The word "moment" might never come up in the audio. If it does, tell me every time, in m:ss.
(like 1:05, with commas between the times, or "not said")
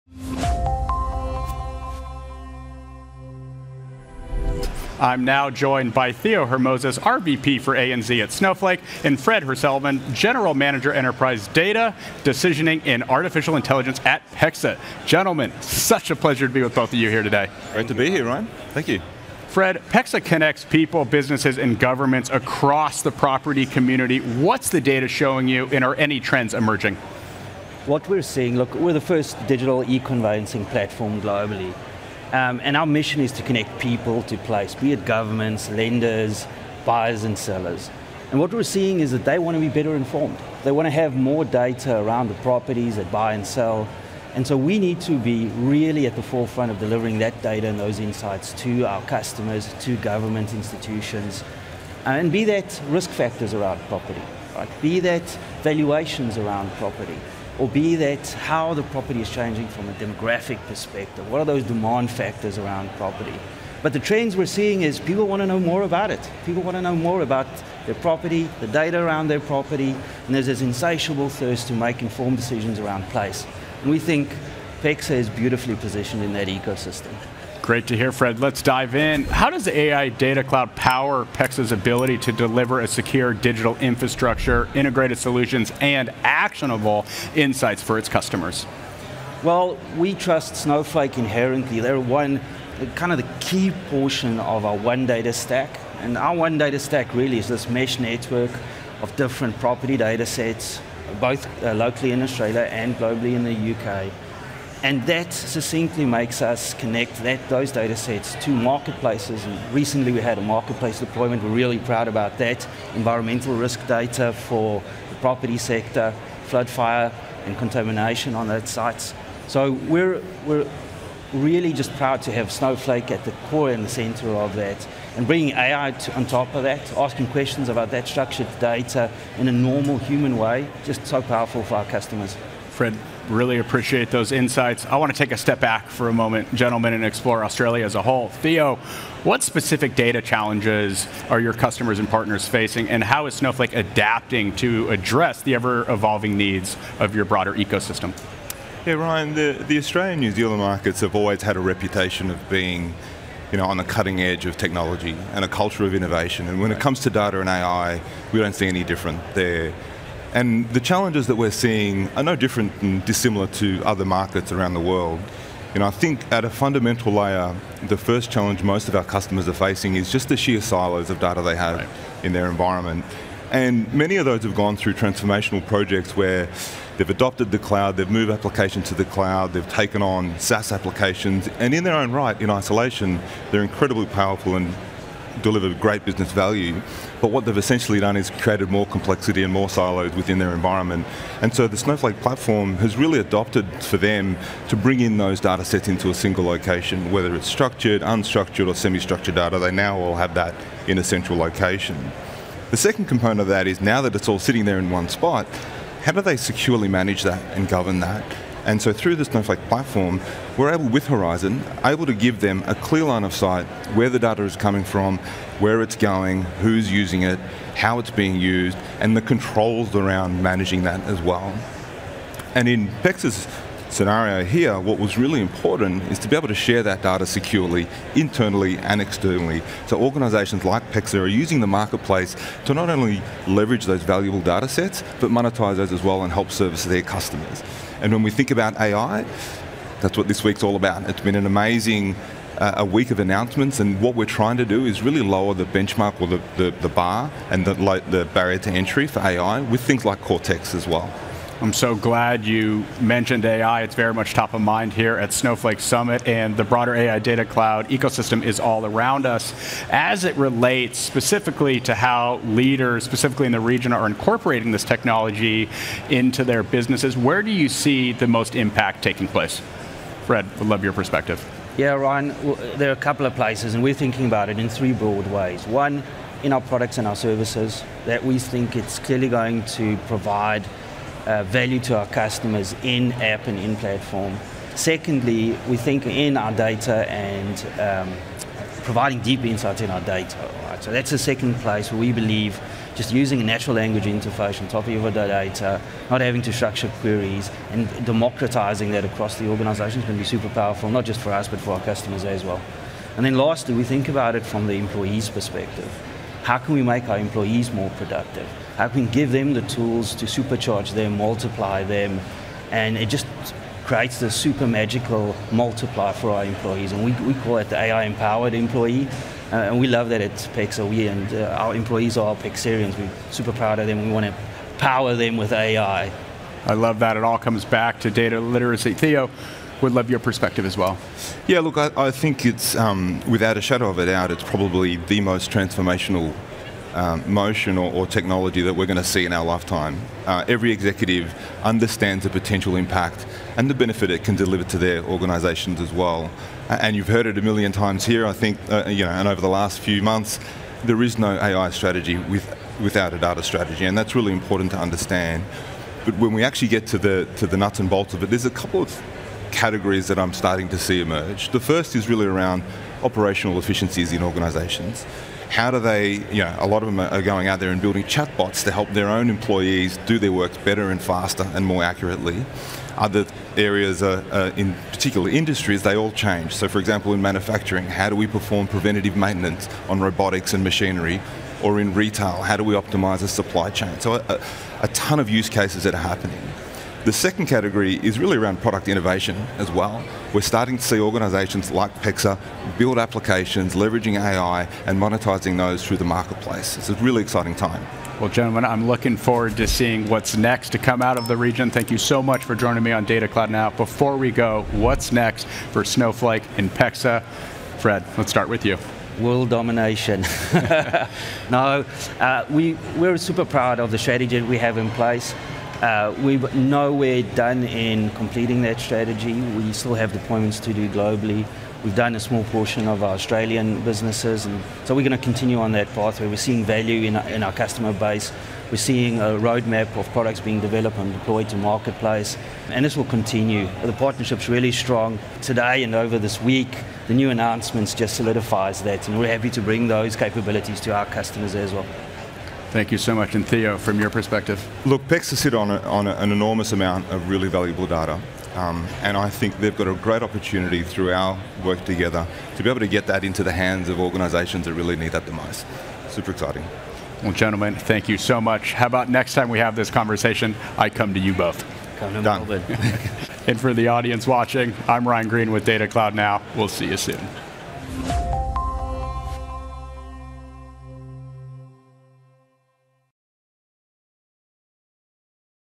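2:16.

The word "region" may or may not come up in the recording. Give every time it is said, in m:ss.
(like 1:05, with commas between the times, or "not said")
4:23, 6:41.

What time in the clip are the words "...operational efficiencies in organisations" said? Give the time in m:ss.
6:03.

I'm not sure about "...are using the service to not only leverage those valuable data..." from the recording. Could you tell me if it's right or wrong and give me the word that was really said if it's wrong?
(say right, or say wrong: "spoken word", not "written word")
wrong: "marketplace", not "service".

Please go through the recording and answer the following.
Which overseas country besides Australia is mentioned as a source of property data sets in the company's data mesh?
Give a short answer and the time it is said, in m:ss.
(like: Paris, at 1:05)
UK, at 1:43.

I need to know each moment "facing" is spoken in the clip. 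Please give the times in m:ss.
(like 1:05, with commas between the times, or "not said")
2:22, 2:49.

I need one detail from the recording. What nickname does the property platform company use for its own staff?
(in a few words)
Pexarians.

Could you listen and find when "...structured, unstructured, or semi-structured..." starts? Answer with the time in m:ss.
3:17.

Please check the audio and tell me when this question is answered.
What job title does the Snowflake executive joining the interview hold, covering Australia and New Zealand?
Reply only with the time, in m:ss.
0:06.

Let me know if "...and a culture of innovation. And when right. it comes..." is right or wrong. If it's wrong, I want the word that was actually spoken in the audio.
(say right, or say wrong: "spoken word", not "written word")
right.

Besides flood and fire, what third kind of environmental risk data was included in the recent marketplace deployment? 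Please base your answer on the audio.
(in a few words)
Contamination.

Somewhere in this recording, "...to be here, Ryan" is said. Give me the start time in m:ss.
0:17.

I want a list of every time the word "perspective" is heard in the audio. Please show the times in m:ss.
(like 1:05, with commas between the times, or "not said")
1:00, 4:30, 5:05, 5:30, 7:24.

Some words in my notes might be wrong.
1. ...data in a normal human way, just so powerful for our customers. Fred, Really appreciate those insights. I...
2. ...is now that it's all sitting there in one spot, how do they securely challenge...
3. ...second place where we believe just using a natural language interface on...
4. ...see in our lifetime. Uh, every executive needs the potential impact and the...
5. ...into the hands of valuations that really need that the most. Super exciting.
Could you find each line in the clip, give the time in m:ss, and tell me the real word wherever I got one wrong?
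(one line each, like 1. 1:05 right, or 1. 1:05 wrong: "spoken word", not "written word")
1. 2:08 right
2. 3:23 wrong: "manage", not "challenge"
3. 4:51 right
4. 5:39 wrong: "understands", not "needs"
5. 7:33 wrong: "organizations", not "valuations".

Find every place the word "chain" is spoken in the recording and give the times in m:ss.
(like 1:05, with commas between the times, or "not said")
6:23.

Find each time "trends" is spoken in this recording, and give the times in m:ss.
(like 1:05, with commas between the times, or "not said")
0:26, 1:03.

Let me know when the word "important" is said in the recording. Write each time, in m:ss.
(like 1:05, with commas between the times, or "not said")
3:45, 5:54.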